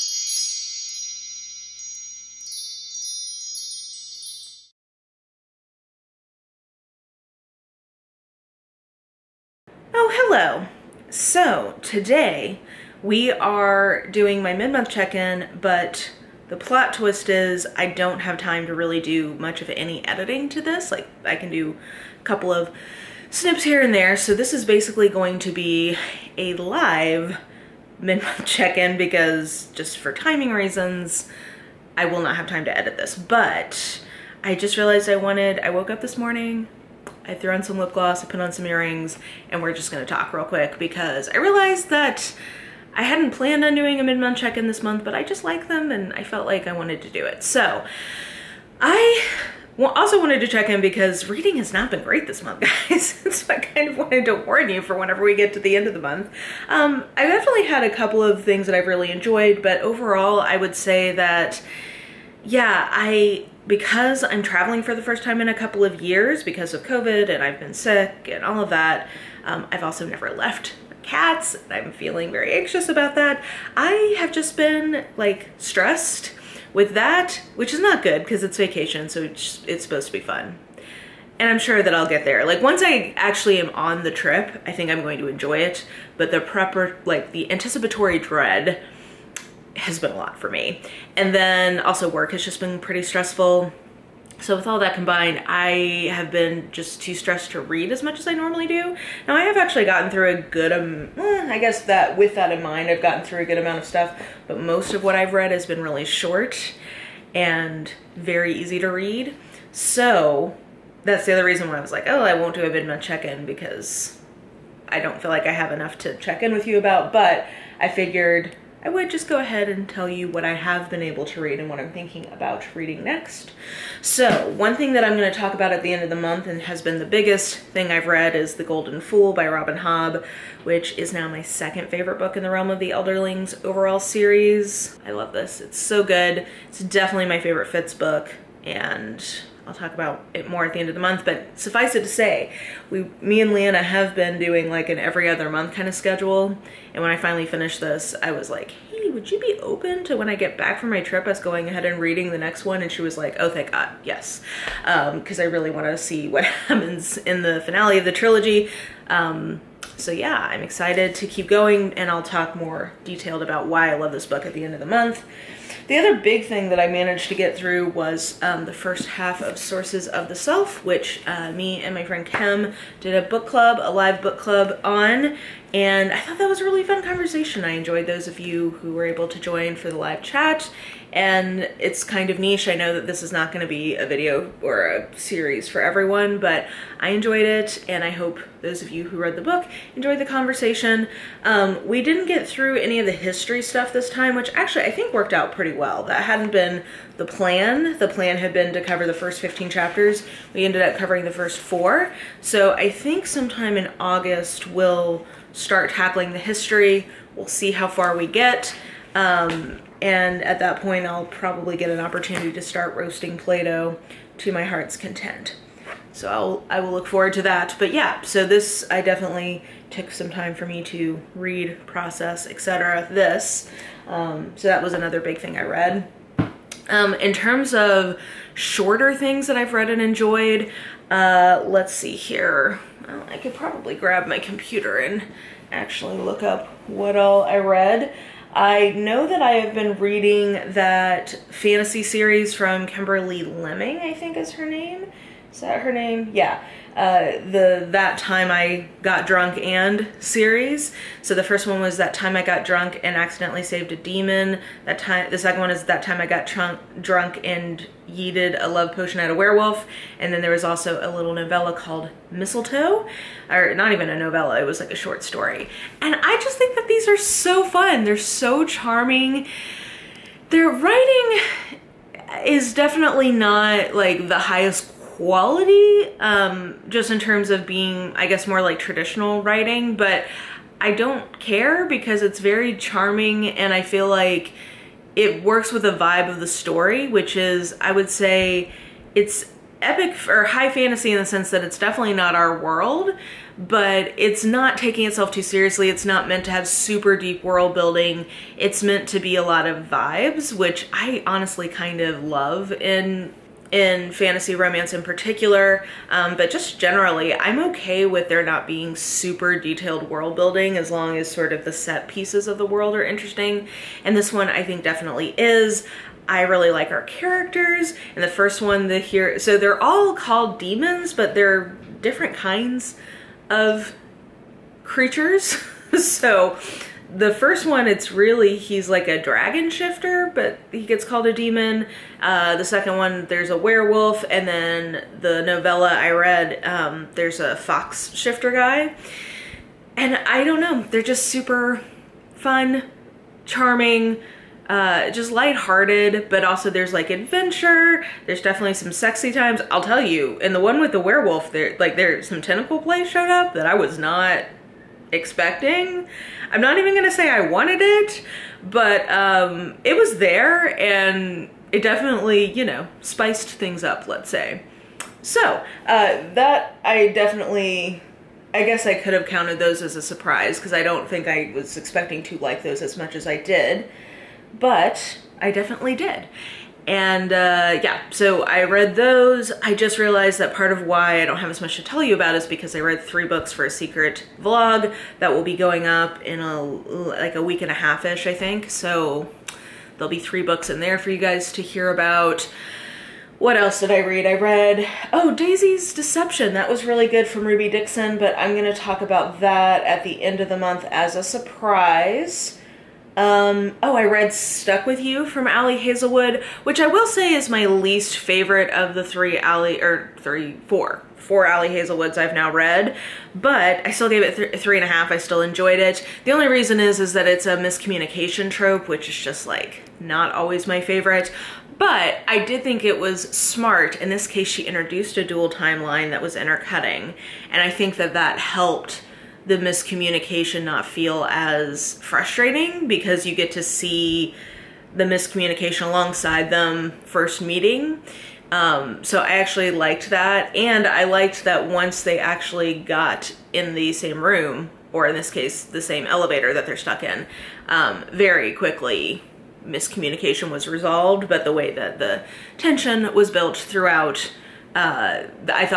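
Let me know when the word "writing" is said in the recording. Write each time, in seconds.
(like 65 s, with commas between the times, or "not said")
270 s, 279 s.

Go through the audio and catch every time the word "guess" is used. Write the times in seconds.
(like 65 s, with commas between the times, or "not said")
101 s, 278 s, 368 s.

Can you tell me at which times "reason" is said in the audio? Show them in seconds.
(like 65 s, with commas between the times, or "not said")
30 s, 111 s, 416 s.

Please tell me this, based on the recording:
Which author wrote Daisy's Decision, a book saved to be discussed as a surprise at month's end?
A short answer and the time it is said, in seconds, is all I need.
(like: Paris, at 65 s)
Ruby Dixon, at 397 s.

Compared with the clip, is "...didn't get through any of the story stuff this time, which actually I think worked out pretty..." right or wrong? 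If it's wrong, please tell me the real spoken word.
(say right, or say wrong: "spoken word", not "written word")
wrong: "history", not "story".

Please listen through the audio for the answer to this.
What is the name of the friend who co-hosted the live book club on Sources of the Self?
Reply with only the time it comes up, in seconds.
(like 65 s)
172 s.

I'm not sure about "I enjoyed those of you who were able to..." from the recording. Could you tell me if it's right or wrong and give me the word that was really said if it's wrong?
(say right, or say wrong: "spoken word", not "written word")
right.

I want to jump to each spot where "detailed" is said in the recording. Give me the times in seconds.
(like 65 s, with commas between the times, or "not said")
163 s, 309 s.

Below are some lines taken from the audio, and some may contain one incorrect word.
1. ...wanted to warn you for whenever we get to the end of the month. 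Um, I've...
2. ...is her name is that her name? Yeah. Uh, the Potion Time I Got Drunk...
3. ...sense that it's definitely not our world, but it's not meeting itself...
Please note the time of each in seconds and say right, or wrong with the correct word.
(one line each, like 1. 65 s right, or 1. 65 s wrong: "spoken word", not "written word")
1. 53 s right
2. 244 s wrong: "That", not "Potion"
3. 291 s wrong: "taking", not "meeting".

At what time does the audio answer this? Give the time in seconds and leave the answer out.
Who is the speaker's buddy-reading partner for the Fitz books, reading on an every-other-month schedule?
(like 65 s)
143 s.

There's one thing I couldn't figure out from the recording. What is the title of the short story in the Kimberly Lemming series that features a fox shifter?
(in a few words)
Mistlefoe.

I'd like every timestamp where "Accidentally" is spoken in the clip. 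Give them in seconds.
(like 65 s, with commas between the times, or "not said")
253 s.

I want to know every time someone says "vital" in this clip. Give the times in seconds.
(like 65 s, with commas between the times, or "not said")
not said.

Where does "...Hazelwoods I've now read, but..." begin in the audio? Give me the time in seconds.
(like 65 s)
411 s.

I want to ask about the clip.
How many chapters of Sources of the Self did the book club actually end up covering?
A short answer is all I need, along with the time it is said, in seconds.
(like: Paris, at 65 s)
4, at 201 s.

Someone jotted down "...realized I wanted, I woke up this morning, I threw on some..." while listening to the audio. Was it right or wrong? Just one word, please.
right.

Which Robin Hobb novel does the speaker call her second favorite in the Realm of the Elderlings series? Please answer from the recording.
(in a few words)
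The Golden Fool.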